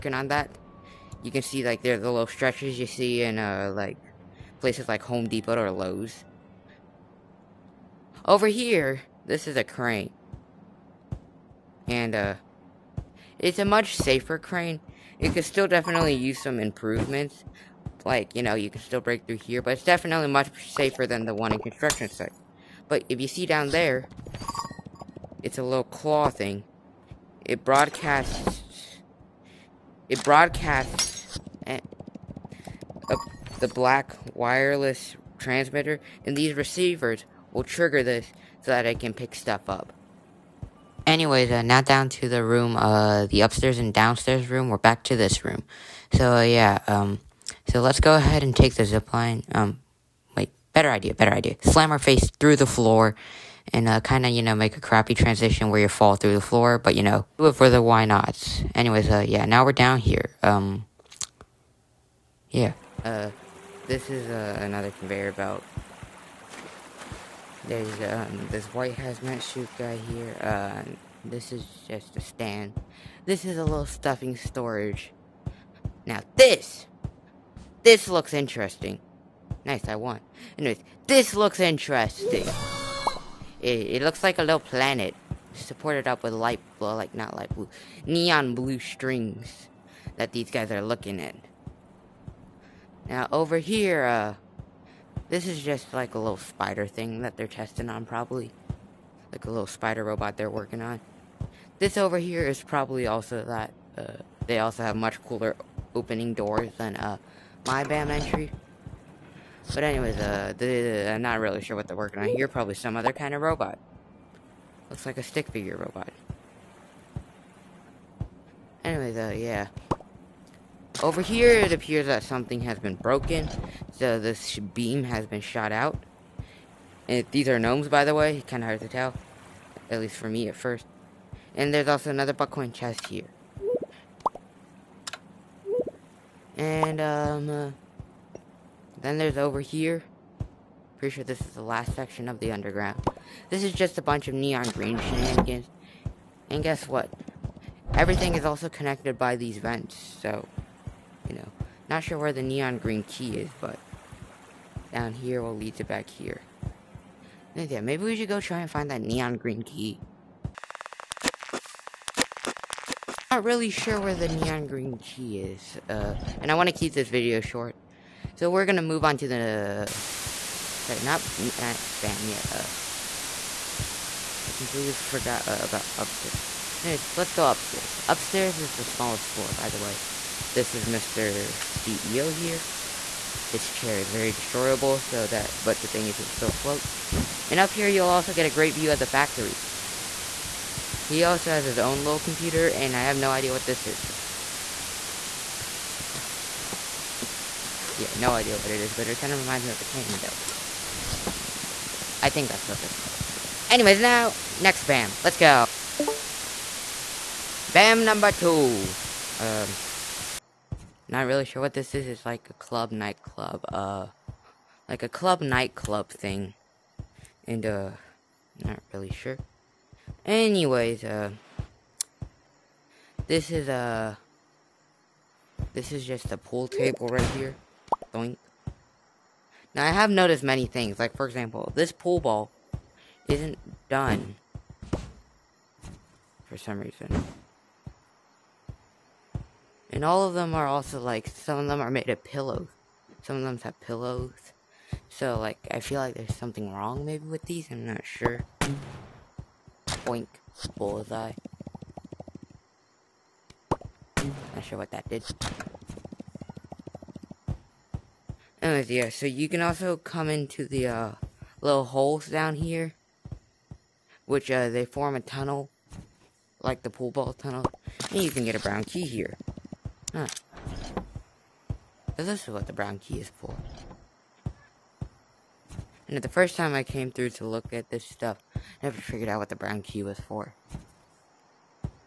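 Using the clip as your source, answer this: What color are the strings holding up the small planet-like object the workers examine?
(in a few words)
Neon blue.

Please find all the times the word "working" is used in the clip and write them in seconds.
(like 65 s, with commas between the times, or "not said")
100 s, 111 s.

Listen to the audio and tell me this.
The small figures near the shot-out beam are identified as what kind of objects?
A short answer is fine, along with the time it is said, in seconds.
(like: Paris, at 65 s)
Gnomes, at 127 s.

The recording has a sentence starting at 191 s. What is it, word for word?
He also has his own little computer, and I have no idea what this is.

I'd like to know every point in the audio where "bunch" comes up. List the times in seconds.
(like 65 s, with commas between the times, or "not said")
144 s.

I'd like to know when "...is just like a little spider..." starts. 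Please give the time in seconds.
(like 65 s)
95 s.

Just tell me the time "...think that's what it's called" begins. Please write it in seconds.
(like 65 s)
202 s.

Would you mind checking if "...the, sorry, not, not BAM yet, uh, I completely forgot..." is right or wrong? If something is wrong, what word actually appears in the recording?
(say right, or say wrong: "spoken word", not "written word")
right.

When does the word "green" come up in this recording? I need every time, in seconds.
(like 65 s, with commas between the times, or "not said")
144 s, 152 s, 159 s, 164 s.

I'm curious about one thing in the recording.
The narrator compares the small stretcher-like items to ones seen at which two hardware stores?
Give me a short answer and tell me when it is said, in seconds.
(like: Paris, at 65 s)
Home Depot or Lowe's, at 5 s.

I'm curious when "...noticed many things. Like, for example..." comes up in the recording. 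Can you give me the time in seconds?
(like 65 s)
230 s.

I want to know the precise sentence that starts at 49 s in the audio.
Um, wait, better idea, better idea.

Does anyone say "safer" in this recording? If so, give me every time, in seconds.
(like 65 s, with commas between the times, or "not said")
13 s, 20 s.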